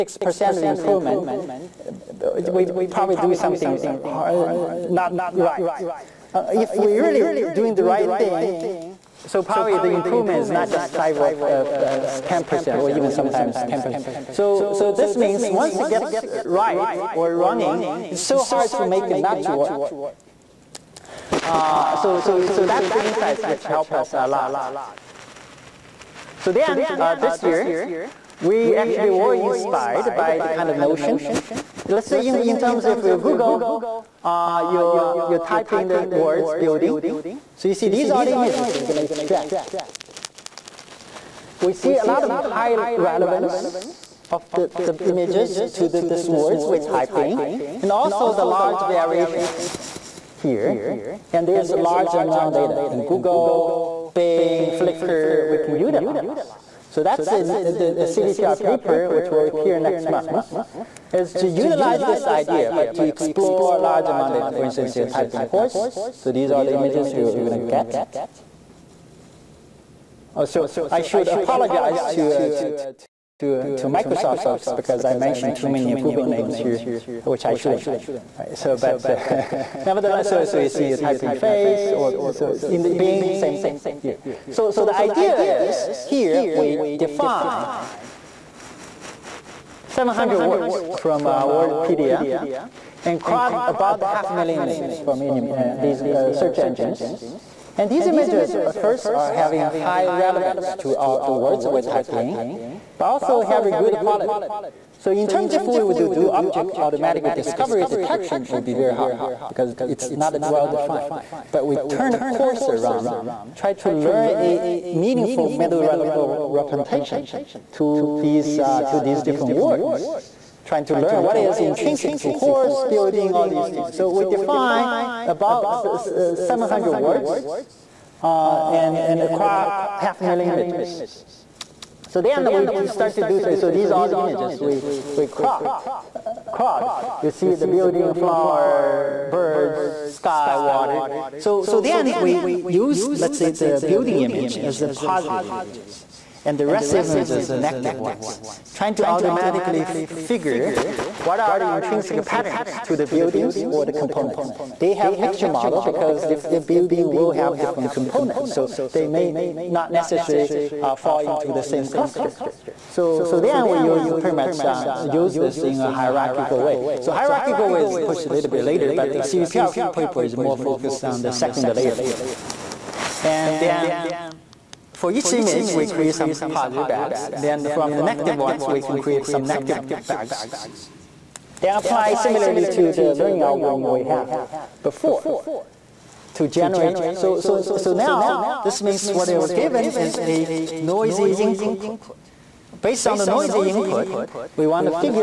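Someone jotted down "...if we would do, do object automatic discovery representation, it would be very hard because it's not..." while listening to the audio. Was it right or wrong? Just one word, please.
wrong.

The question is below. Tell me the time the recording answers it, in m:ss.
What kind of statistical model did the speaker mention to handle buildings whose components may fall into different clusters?
2:35.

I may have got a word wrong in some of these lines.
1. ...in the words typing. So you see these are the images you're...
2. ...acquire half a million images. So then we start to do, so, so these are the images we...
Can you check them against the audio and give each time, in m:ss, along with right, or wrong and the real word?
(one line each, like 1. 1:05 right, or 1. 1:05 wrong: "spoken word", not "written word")
1. 0:35 wrong: "building", not "typing"
2. 2:09 right.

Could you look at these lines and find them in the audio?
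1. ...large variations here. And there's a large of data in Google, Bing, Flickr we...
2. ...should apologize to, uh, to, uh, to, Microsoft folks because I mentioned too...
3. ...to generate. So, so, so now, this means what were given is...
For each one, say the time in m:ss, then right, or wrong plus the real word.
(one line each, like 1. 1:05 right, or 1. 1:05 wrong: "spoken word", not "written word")
1. 0:48 right
2. 1:11 right
3. 3:06 right.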